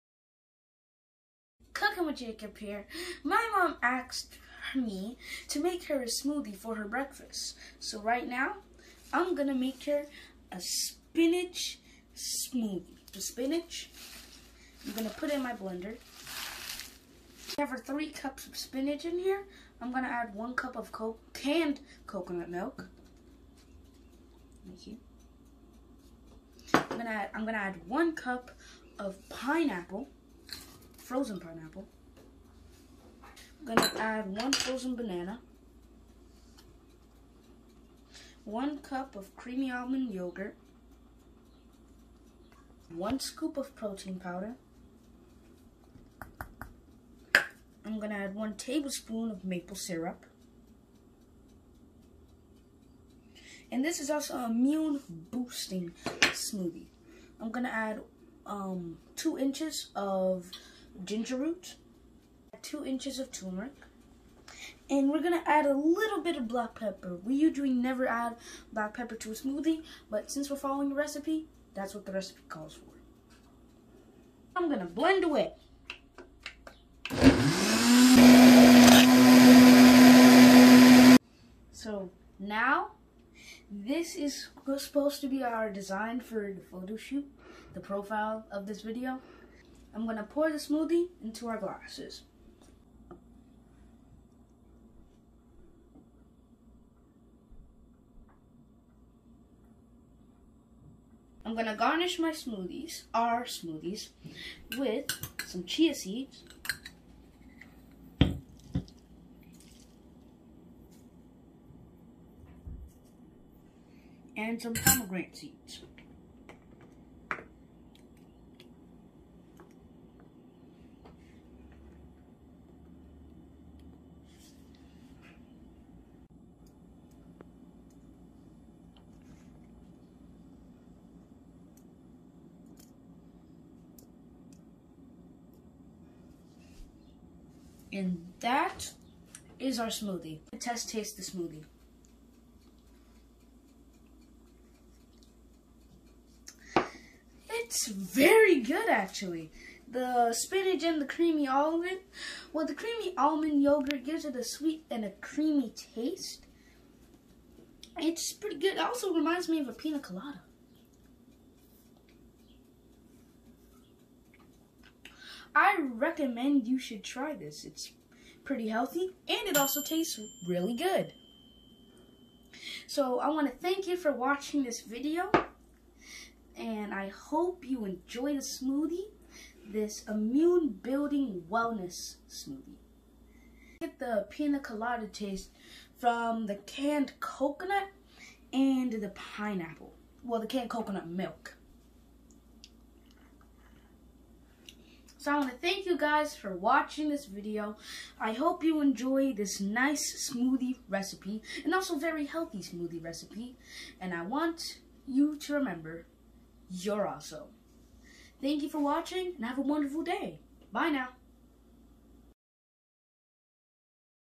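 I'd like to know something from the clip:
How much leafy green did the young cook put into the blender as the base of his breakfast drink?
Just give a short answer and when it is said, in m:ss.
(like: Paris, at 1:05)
3 cups, at 0:17.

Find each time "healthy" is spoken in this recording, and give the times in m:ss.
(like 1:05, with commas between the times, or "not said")
2:48, 3:22.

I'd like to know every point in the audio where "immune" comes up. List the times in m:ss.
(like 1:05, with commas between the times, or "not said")
0:54, 3:00.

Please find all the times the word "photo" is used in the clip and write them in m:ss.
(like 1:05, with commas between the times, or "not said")
1:26.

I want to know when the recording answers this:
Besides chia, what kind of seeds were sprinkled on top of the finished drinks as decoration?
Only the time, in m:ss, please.
1:54.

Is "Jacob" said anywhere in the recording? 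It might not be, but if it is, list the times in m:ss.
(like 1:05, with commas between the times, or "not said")
0:02.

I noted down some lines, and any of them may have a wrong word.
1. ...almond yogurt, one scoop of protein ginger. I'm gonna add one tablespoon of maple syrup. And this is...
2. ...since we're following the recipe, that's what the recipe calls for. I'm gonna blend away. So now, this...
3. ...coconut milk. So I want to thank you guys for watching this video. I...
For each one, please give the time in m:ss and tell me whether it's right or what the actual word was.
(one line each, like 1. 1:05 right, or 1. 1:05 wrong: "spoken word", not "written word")
1. 0:39 wrong: "powder", not "ginger"
2. 1:10 right
3. 3:10 right.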